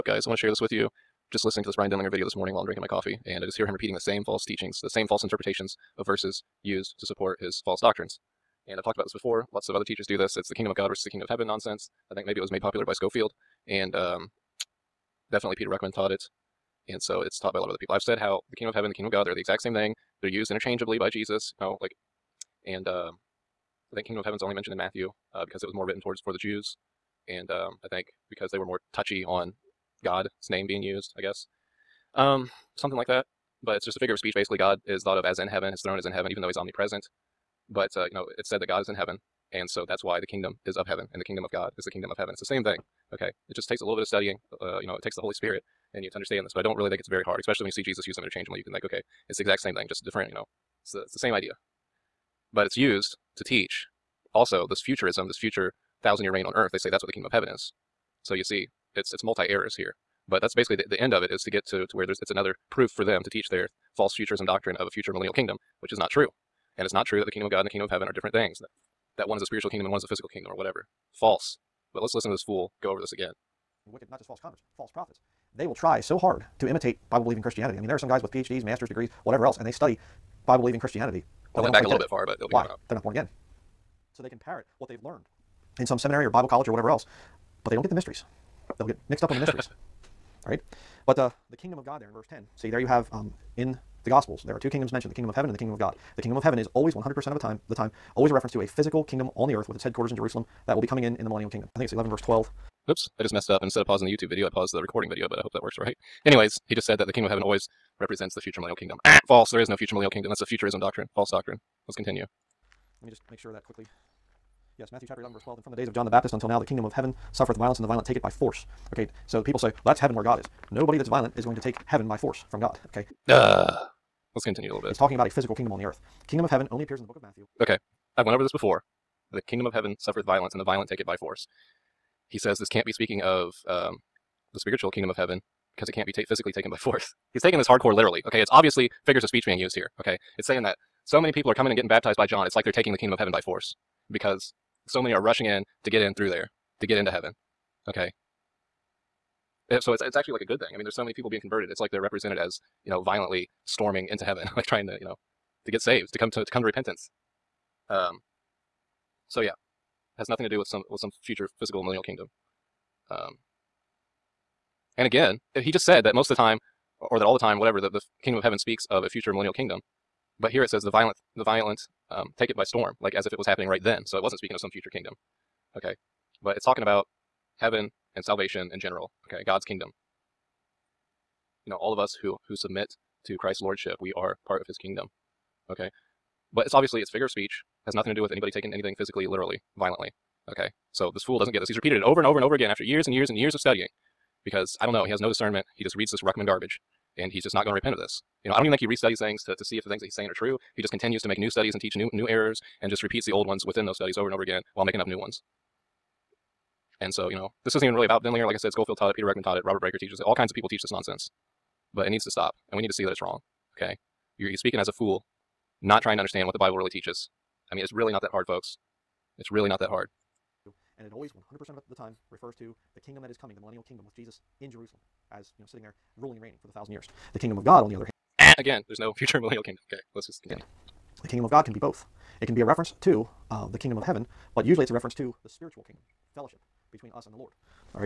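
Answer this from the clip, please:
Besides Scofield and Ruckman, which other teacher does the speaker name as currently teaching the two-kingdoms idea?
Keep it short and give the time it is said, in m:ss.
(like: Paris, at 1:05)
Robert Breaker, at 3:29.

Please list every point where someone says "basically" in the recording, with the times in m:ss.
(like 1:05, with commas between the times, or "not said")
0:34, 1:00.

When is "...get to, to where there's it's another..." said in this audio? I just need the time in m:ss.
1:01.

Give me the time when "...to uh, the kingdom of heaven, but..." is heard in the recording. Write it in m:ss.
3:53.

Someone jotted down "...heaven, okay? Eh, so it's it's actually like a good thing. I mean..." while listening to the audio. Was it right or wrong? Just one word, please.
right.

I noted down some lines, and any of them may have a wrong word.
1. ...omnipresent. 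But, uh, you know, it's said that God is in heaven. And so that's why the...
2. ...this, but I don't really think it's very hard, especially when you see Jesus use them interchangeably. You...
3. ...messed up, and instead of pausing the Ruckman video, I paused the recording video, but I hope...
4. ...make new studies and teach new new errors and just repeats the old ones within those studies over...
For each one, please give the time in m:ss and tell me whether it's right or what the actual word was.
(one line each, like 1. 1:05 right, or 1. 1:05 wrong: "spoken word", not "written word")
1. 0:36 right
2. 0:46 right
3. 1:43 wrong: "YouTube", not "Ruckman"
4. 3:21 right.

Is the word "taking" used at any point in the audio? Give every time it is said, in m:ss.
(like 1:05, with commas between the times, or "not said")
2:17, 2:22, 3:08.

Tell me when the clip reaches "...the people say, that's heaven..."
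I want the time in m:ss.
1:59.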